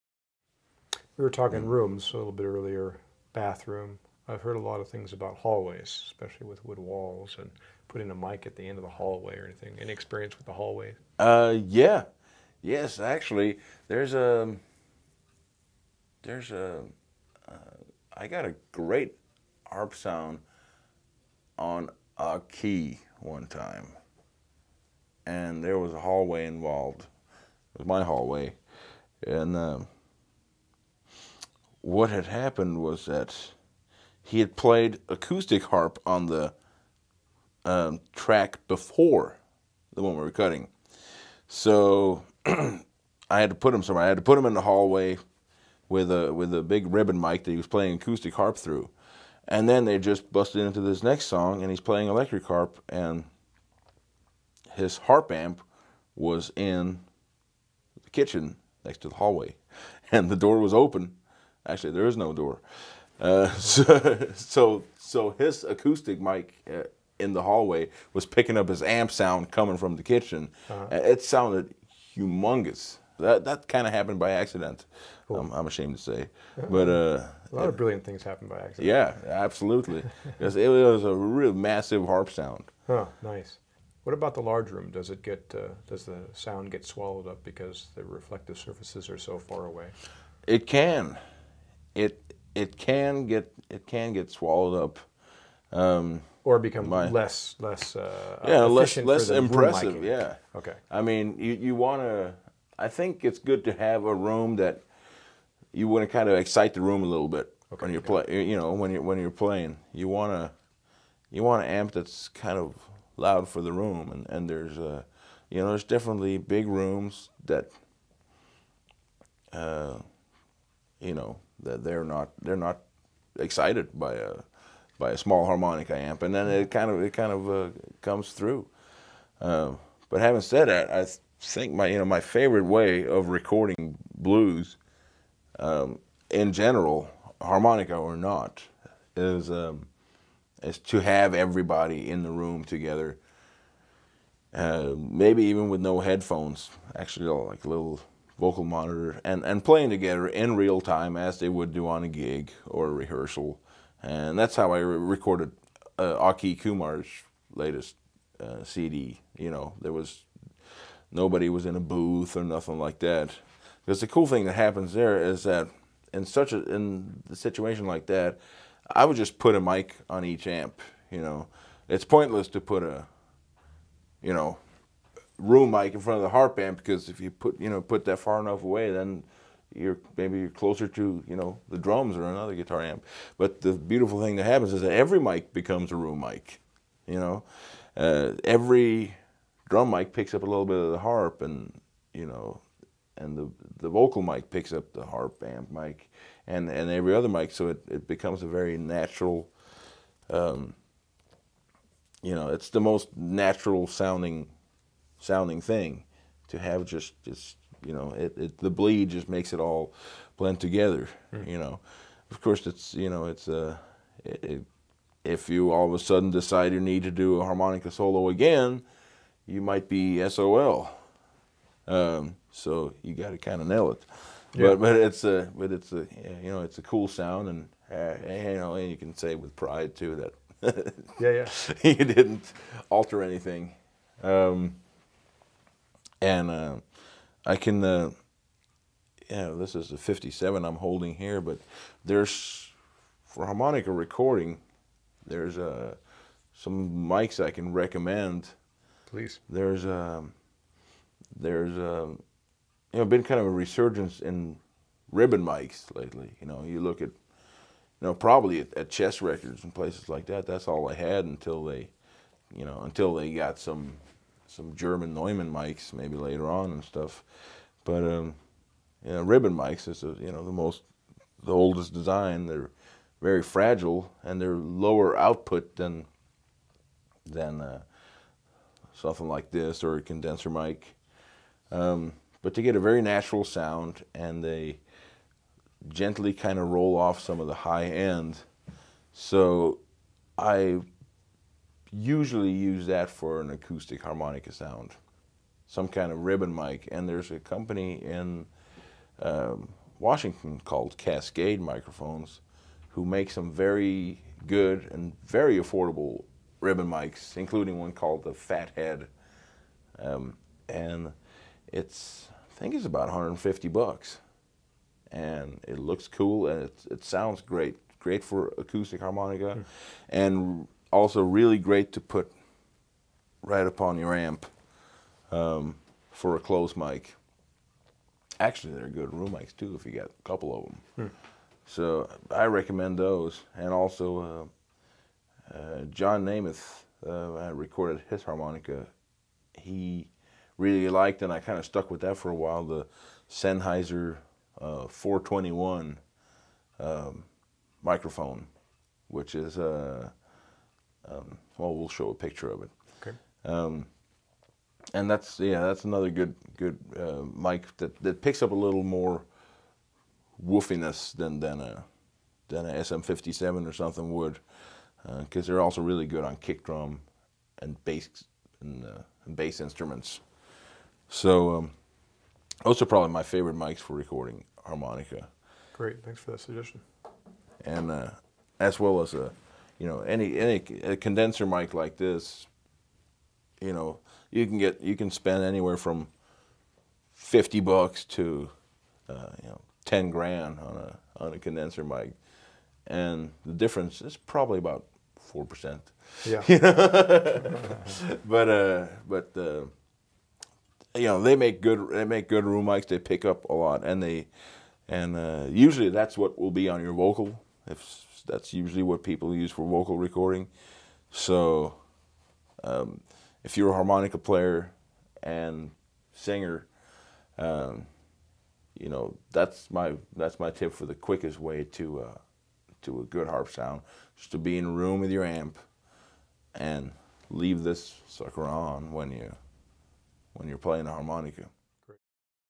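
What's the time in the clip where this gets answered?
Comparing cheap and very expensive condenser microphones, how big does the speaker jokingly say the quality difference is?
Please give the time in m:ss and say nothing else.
6:35.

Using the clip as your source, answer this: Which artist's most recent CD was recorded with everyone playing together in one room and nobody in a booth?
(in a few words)
Aki Kumar.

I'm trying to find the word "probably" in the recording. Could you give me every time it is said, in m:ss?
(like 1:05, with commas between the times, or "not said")
4:18, 6:12, 6:34.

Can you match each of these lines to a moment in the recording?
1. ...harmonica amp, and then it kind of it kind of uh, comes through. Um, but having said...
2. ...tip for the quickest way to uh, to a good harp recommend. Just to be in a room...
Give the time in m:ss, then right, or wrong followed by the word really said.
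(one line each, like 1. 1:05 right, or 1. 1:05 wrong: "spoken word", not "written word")
1. 2:05 right
2. 7:00 wrong: "sound", not "recommend".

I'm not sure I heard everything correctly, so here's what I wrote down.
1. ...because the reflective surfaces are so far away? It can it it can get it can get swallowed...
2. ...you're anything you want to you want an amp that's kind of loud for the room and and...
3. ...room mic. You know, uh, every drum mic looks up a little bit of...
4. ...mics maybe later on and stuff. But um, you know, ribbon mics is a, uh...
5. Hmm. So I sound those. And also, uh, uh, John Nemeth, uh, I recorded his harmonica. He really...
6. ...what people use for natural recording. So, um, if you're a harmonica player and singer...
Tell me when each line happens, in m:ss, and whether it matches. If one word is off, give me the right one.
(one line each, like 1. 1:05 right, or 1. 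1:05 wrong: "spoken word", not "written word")
1. 1:27 right
2. 1:49 wrong: "playing", not "anything"
3. 3:05 wrong: "picks", not "looks"
4. 4:25 right
5. 5:30 wrong: "recommend", not "sound"
6. 6:48 wrong: "vocal", not "natural".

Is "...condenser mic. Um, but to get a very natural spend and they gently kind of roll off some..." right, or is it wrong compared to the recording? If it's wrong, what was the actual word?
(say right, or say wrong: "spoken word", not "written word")
wrong: "sound", not "spend".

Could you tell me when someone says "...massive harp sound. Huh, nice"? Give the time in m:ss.
1:21.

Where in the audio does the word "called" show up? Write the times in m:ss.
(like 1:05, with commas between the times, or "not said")
5:00, 5:07.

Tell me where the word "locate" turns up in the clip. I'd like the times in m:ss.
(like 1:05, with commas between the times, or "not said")
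not said.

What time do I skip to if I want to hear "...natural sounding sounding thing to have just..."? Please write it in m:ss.
3:23.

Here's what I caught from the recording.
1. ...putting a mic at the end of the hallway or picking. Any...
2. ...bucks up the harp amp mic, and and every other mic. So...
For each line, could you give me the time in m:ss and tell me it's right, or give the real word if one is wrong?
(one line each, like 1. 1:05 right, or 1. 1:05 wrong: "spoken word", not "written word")
1. 0:07 wrong: "anything", not "picking"
2. 3:14 wrong: "picks", not "bucks".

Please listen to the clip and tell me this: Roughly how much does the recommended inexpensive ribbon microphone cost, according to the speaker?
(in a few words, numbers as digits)
$150.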